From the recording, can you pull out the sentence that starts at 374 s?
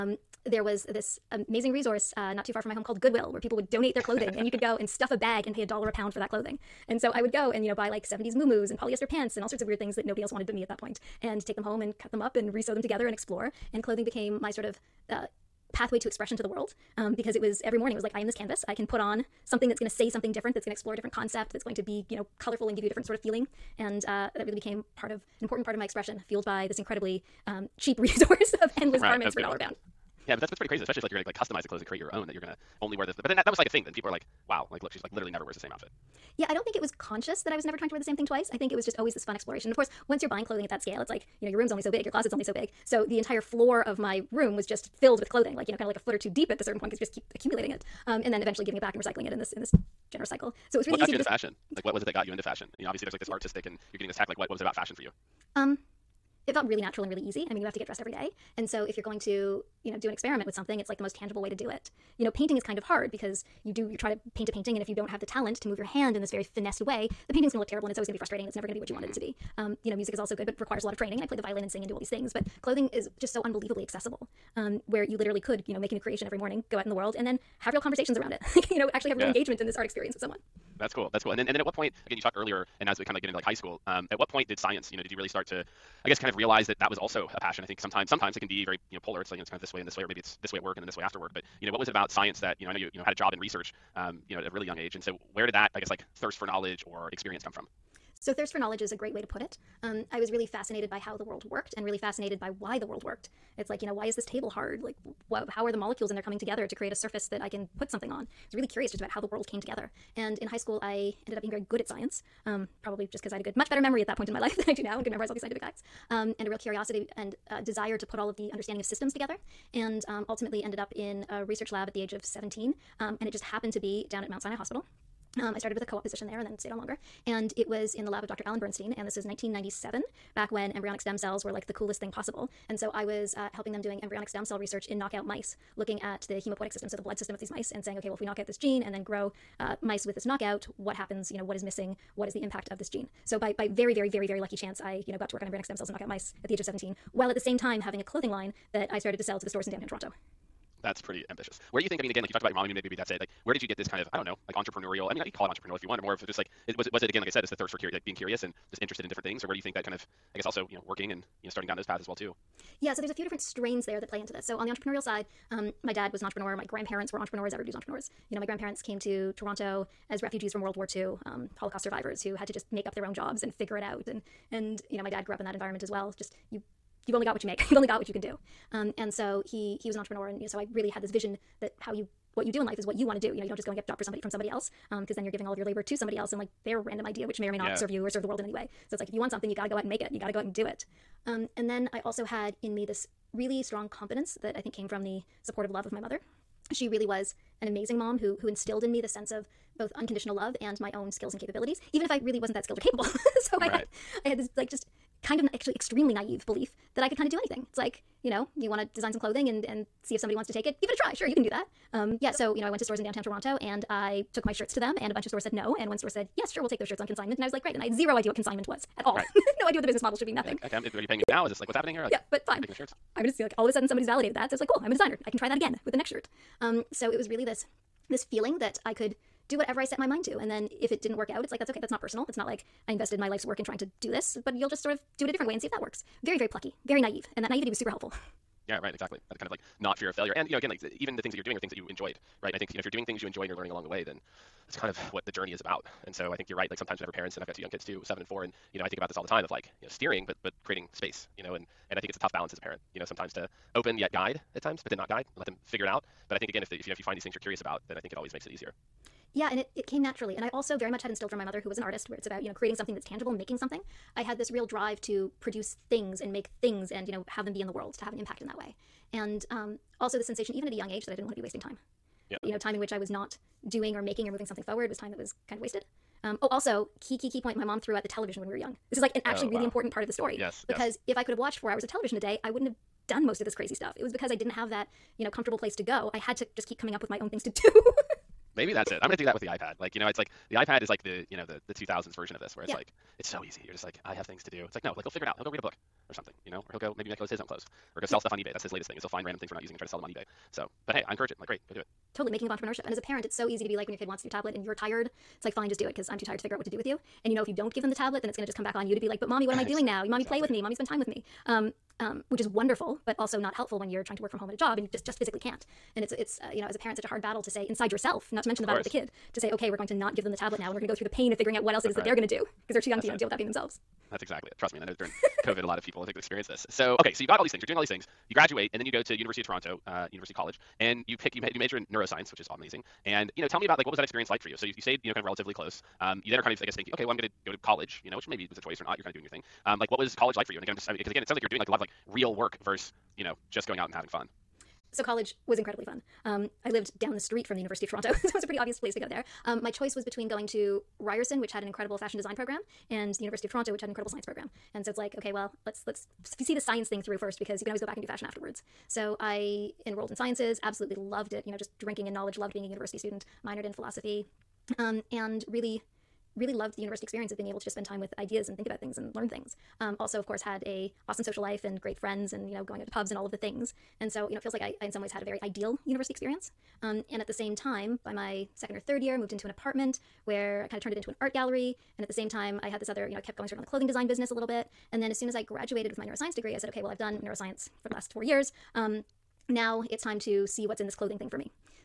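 And so, you know, it feels like I, I in some ways had a very ideal university experience.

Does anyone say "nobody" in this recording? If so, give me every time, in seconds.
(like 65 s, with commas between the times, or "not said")
10 s.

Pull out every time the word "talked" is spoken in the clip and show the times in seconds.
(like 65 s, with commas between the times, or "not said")
82 s, 152 s.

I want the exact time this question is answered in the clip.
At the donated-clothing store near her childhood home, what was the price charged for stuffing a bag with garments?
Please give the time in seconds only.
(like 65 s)
5 s.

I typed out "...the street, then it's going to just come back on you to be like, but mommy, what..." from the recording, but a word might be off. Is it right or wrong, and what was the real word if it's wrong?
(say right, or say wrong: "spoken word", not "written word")
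wrong: "tablet", not "street".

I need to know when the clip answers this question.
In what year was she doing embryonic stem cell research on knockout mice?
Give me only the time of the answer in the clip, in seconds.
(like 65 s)
129 s.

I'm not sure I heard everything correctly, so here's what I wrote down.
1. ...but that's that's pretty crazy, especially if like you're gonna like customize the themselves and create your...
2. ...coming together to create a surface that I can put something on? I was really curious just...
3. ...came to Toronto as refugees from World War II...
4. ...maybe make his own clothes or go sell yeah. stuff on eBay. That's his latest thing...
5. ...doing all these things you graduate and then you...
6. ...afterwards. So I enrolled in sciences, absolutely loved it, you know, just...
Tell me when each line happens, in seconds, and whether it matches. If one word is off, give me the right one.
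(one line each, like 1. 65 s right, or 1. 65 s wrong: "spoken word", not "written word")
1. 30 s wrong: "clothes", not "themselves"
2. 106 s right
3. 168 s right
4. 296 s right
5. 327 s right
6. 358 s right.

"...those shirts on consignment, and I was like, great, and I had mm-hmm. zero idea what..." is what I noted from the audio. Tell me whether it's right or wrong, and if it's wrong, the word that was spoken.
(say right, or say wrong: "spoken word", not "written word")
right.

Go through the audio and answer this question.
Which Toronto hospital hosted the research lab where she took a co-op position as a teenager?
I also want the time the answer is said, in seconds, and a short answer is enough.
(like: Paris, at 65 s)
Mount Sinai Hospital, at 124 s.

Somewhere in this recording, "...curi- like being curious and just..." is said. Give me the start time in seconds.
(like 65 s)
157 s.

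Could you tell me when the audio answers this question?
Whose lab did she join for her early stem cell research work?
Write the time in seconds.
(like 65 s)
128 s.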